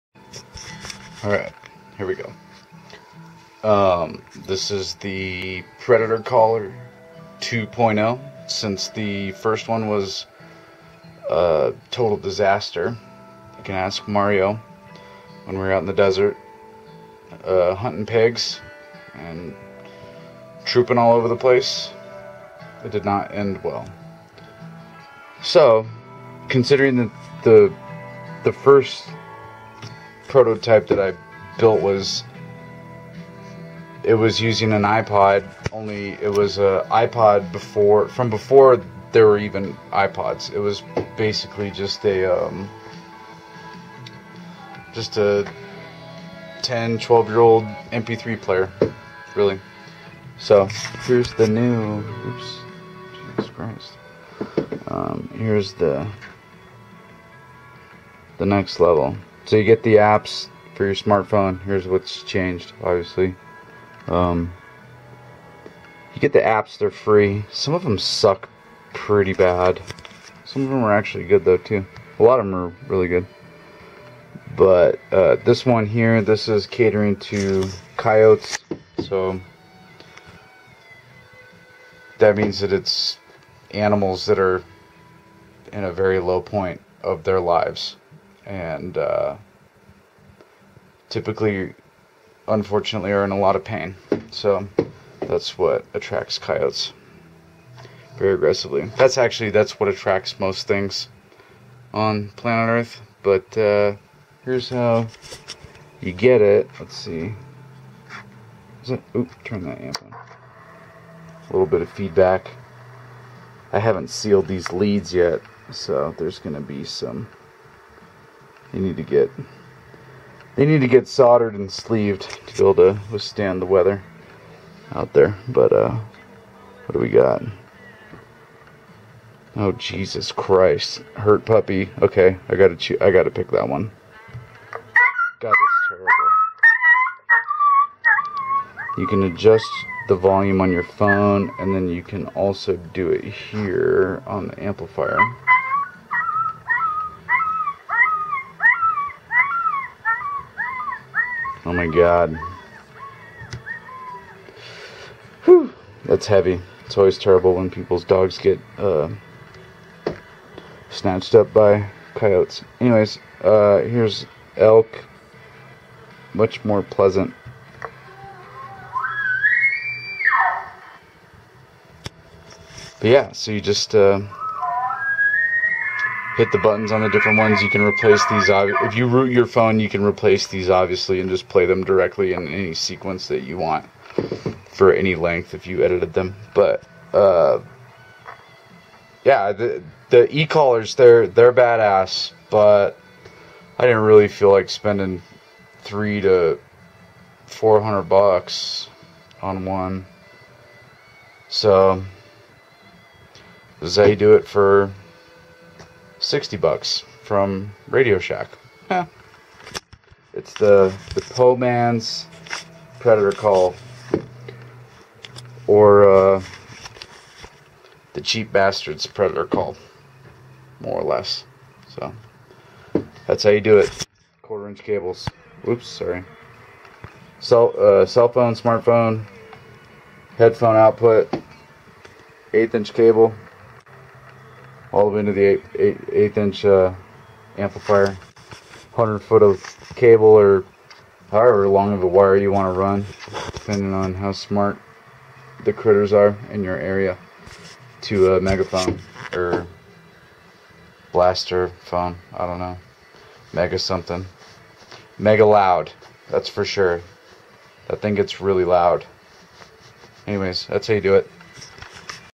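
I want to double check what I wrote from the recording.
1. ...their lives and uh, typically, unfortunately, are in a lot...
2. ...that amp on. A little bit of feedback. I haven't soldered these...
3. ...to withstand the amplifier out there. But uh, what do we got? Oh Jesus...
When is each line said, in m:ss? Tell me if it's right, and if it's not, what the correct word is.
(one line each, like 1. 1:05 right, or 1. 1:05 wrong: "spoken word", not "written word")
1. 1:27 right
2. 1:49 wrong: "sealed", not "soldered"
3. 2:02 wrong: "weather", not "amplifier".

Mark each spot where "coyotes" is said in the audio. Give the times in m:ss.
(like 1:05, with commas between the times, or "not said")
1:17, 1:36, 2:42.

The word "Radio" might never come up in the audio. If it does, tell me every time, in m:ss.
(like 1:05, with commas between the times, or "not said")
3:27.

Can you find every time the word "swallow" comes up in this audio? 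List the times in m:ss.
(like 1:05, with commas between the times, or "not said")
not said.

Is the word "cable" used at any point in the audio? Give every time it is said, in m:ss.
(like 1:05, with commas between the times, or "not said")
3:44, 3:52, 3:59.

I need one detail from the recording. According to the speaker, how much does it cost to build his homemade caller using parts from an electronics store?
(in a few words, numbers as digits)
60 bucks.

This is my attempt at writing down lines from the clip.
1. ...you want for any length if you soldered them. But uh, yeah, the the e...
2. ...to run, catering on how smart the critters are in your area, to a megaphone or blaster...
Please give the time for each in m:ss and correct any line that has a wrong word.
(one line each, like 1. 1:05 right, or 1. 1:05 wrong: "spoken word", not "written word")
1. 3:03 wrong: "edited", not "soldered"
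2. 4:02 wrong: "depending", not "catering".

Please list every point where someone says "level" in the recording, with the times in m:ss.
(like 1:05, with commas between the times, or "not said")
0:58.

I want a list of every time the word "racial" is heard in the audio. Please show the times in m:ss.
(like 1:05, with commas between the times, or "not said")
not said.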